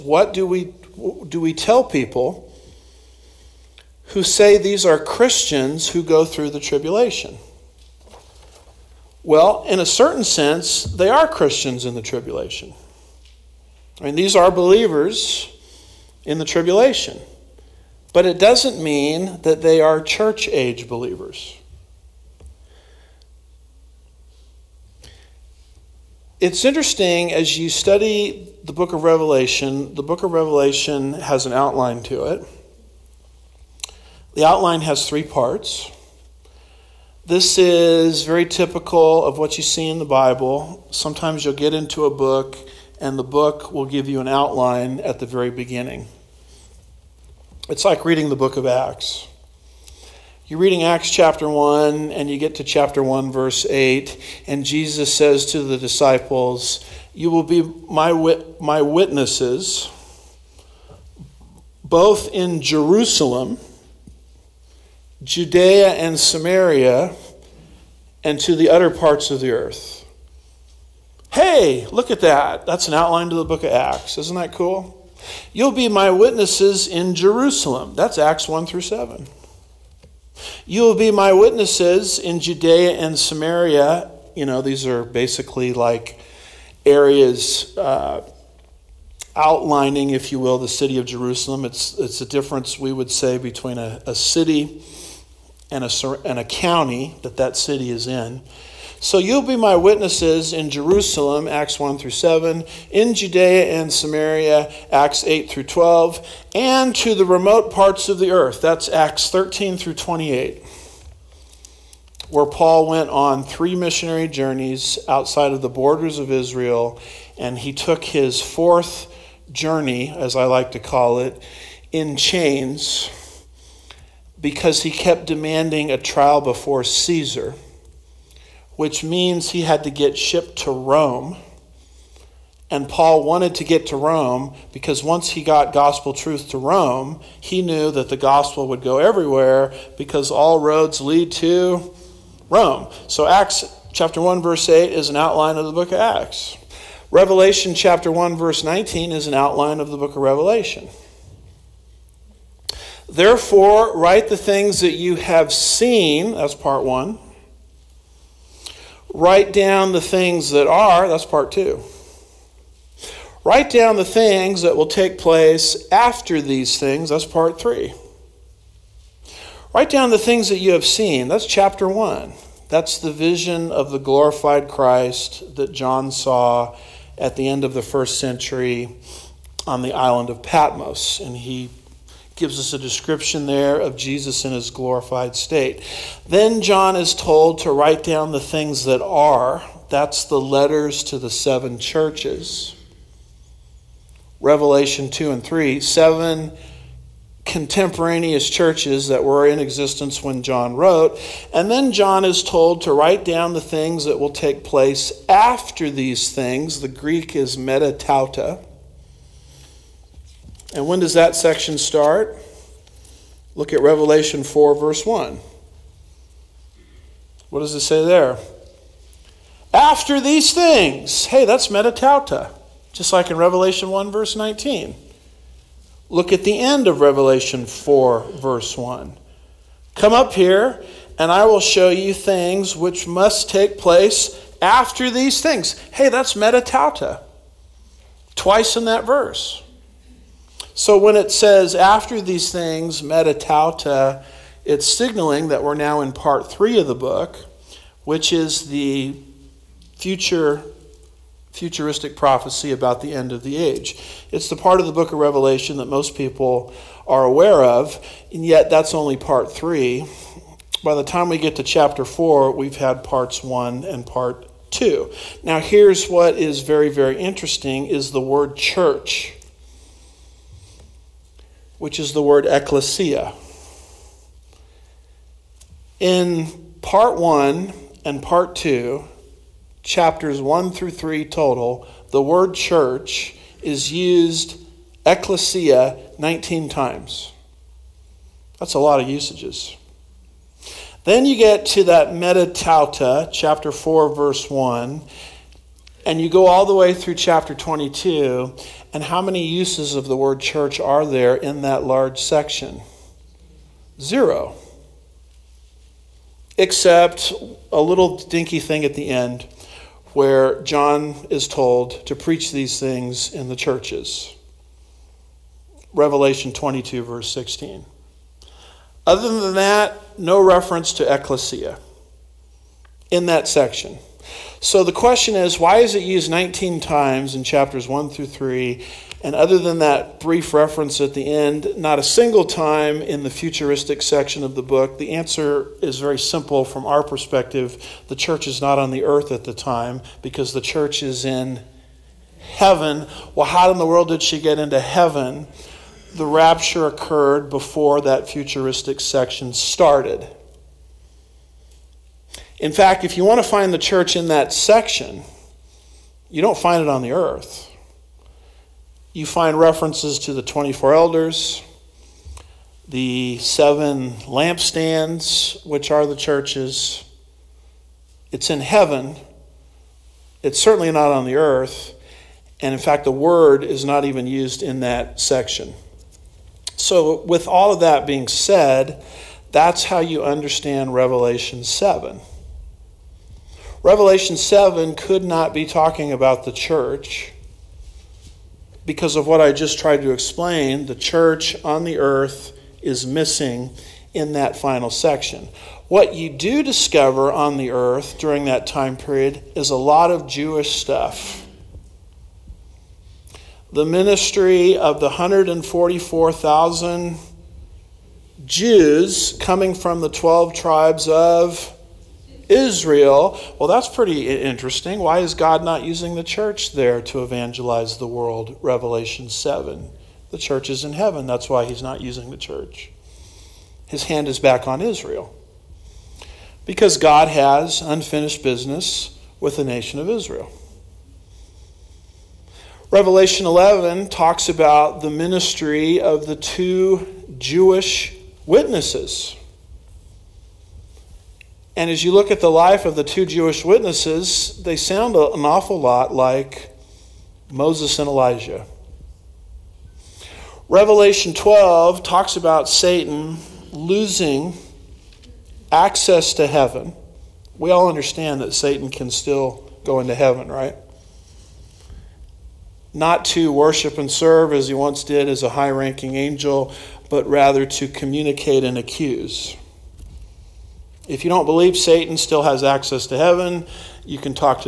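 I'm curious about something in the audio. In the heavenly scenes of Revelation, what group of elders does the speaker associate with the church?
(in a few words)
24 elders.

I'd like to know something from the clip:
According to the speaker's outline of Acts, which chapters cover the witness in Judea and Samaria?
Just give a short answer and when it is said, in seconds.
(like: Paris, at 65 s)
Acts 8 through 12, at 104 s.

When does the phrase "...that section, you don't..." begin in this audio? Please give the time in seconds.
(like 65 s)
354 s.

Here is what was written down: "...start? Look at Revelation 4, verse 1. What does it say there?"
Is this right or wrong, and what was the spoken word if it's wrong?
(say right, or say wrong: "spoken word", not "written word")
right.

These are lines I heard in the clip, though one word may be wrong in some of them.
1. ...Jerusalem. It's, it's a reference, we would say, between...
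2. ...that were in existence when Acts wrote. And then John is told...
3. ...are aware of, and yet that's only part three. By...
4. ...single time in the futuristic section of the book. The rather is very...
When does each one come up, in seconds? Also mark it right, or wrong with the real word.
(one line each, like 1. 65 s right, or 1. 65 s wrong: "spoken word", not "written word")
1. 91 s wrong: "difference", not "reference"
2. 199 s wrong: "John", not "Acts"
3. 257 s right
4. 332 s wrong: "answer", not "rather".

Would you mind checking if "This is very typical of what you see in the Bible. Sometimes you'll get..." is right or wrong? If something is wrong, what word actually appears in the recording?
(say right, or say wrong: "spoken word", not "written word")
right.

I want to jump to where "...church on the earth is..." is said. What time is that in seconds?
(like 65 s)
390 s.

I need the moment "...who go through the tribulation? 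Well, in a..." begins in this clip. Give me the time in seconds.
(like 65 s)
5 s.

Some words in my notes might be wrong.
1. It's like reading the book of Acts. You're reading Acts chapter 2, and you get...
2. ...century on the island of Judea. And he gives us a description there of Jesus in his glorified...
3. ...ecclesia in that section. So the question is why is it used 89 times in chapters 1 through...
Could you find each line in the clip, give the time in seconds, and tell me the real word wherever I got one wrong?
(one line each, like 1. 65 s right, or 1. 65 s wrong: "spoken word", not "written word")
1. 47 s wrong: "1", not "2"
2. 178 s wrong: "Patmos", not "Judea"
3. 321 s wrong: "19", not "89".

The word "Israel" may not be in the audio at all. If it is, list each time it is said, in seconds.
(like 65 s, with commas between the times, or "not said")
116 s, 412 s, 424 s, 430 s.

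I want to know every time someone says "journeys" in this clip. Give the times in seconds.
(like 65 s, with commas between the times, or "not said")
114 s, 119 s.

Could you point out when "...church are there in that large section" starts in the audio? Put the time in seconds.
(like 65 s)
300 s.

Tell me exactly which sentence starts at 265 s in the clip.
Now here's what is very, very interesting is the word church which is the word ecclesia.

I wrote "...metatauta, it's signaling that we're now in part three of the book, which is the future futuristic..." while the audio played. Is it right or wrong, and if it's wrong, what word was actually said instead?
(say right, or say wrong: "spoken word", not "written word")
right.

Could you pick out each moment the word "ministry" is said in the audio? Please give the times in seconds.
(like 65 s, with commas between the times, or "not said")
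403 s, 435 s.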